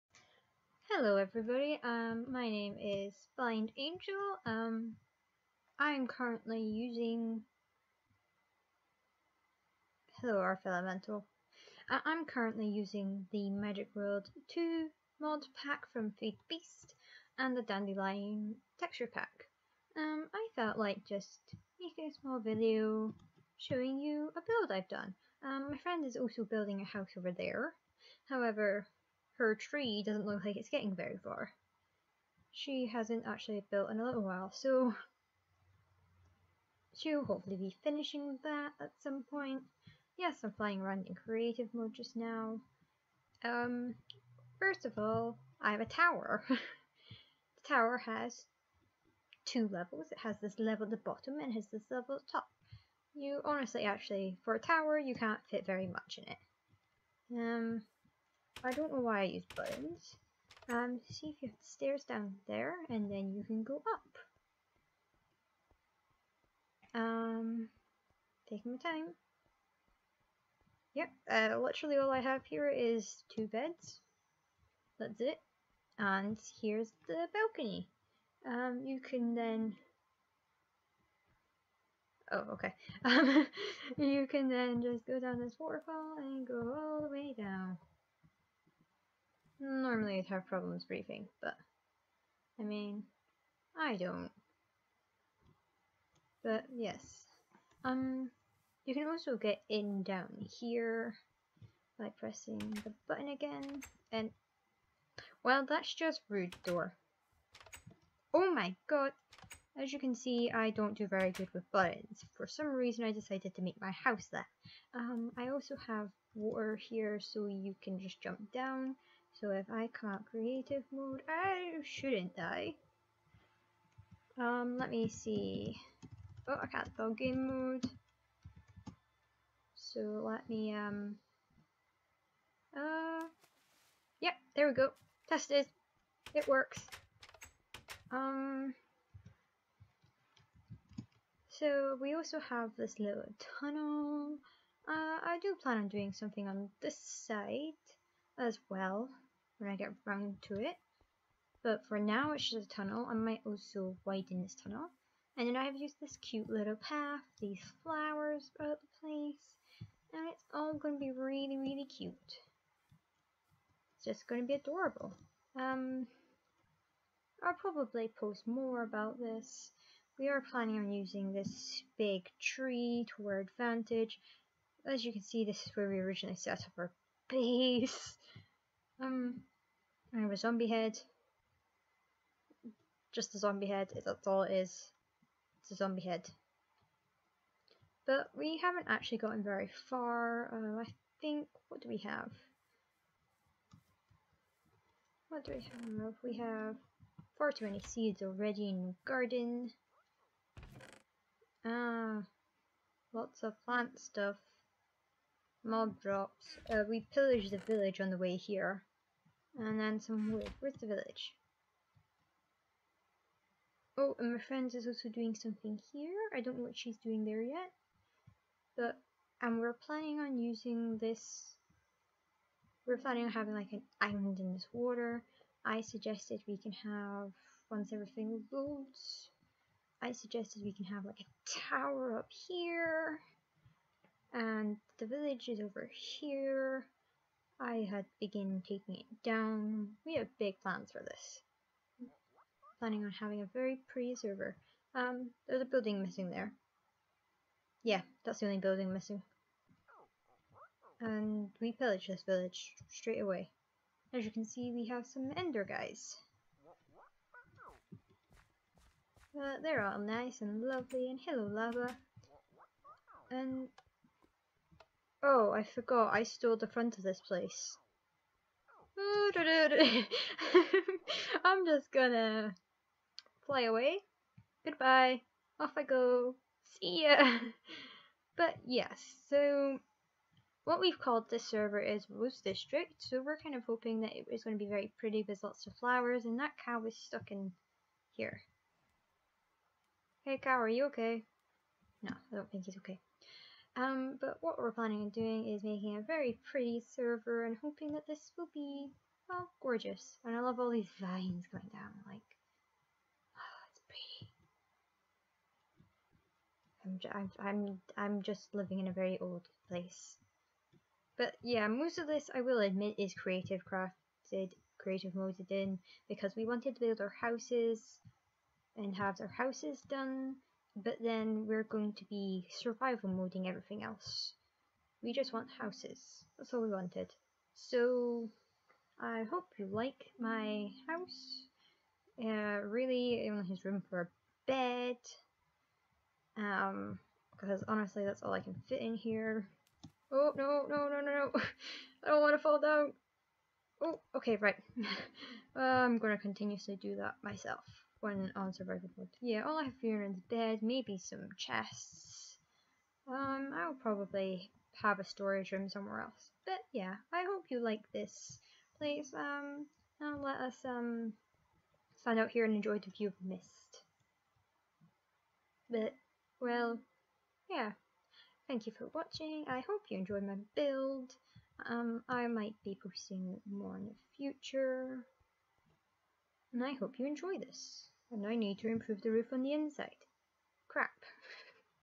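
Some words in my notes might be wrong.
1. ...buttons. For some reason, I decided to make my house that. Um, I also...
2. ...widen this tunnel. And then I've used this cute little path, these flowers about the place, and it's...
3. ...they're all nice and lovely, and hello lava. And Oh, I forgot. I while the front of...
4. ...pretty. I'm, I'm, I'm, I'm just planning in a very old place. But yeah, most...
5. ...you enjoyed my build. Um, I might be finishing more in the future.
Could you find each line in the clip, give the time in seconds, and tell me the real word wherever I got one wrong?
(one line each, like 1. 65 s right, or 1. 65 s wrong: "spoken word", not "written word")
1. 111 s right
2. 154 s right
3. 259 s wrong: "stole", not "while"
4. 306 s wrong: "living", not "planning"
5. 369 s wrong: "posting", not "finishing".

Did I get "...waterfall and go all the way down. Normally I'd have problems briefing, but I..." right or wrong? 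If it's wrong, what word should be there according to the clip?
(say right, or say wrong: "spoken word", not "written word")
right.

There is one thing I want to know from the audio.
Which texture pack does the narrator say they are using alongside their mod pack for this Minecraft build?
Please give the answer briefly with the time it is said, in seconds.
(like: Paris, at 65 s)
Dandelion, at 17 s.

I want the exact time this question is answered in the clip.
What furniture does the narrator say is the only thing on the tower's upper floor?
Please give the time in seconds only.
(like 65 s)
73 s.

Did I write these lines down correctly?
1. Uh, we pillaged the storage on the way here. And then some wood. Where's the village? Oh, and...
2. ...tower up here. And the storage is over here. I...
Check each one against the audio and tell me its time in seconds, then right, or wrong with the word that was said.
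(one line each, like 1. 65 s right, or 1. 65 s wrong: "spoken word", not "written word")
1. 206 s wrong: "village", not "storage"
2. 231 s wrong: "village", not "storage".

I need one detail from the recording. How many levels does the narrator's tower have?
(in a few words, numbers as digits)
2.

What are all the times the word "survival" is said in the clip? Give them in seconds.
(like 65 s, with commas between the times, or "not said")
322 s, 348 s.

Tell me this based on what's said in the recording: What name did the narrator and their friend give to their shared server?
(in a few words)
Rose District.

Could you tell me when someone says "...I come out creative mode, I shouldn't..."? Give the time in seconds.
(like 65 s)
119 s.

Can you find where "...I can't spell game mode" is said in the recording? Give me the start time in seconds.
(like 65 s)
126 s.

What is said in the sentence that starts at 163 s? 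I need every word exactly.
It's just going to be adorable.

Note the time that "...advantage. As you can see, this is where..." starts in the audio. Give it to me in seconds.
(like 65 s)
173 s.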